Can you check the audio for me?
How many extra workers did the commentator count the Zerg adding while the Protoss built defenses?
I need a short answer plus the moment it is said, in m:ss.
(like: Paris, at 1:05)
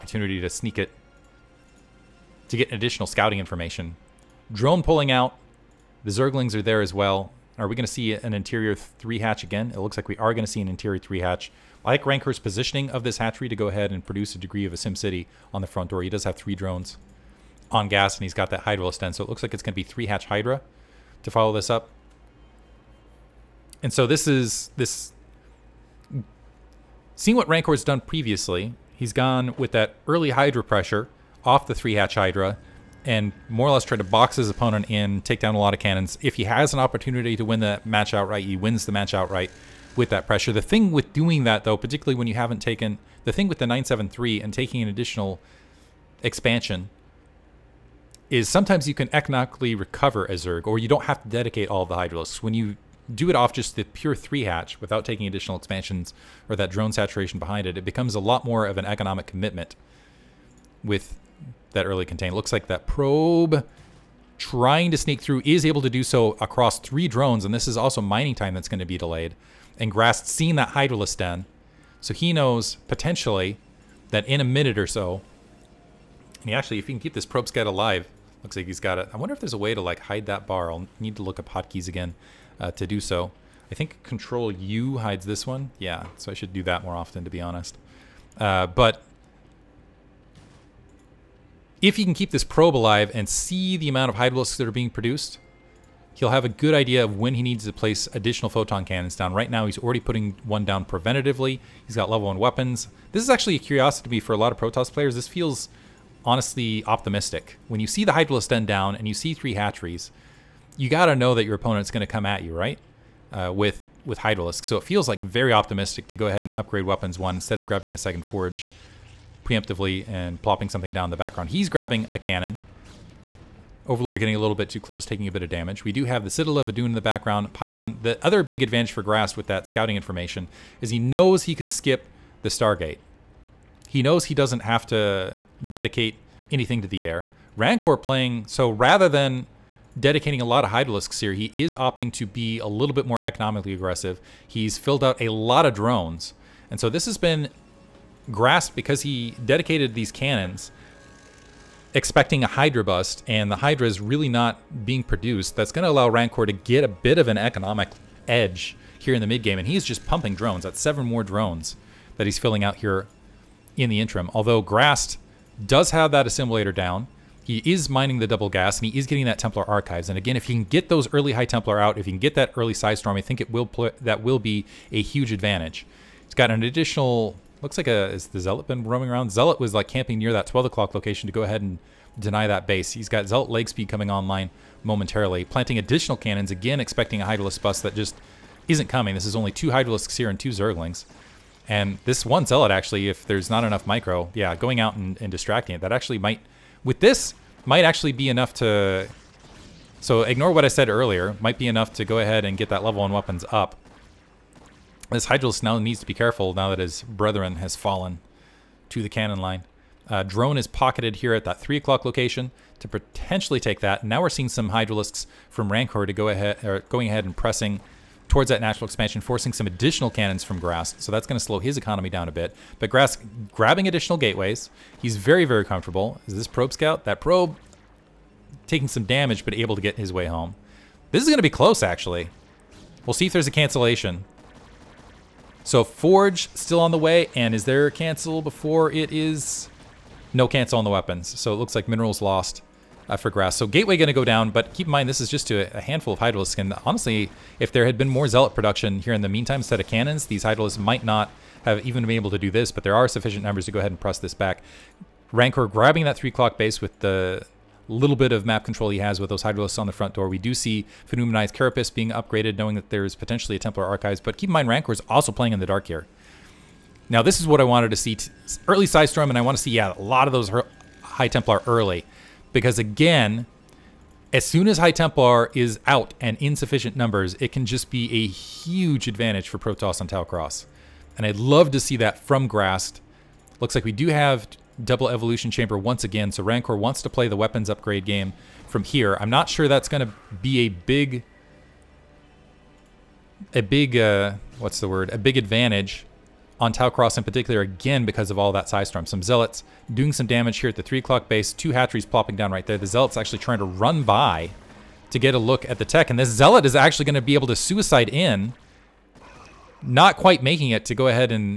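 7, at 2:40.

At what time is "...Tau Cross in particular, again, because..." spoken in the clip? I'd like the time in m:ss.
4:56.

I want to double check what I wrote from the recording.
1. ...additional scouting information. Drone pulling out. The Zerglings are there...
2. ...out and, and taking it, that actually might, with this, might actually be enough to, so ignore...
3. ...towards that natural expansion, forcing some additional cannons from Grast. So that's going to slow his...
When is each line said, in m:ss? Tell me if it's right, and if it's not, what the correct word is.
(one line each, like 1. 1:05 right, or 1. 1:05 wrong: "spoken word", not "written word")
1. 0:02 right
2. 3:14 wrong: "distracting", not "taking"
3. 3:38 right.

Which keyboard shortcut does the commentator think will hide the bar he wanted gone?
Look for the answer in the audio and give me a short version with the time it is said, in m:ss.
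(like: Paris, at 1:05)
Control U, at 1:24.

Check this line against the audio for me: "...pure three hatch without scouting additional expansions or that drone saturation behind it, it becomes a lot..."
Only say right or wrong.
wrong.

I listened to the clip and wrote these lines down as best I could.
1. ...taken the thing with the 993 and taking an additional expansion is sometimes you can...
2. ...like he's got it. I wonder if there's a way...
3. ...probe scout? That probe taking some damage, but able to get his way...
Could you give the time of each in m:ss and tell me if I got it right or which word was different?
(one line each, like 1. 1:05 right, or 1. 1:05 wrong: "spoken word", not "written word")
1. 0:42 wrong: "973", not "993"
2. 1:18 right
3. 3:46 right.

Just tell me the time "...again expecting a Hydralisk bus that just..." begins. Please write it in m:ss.
3:06.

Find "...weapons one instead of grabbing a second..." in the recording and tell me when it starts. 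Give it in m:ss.
1:56.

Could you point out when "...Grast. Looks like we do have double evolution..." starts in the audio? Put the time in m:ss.
4:42.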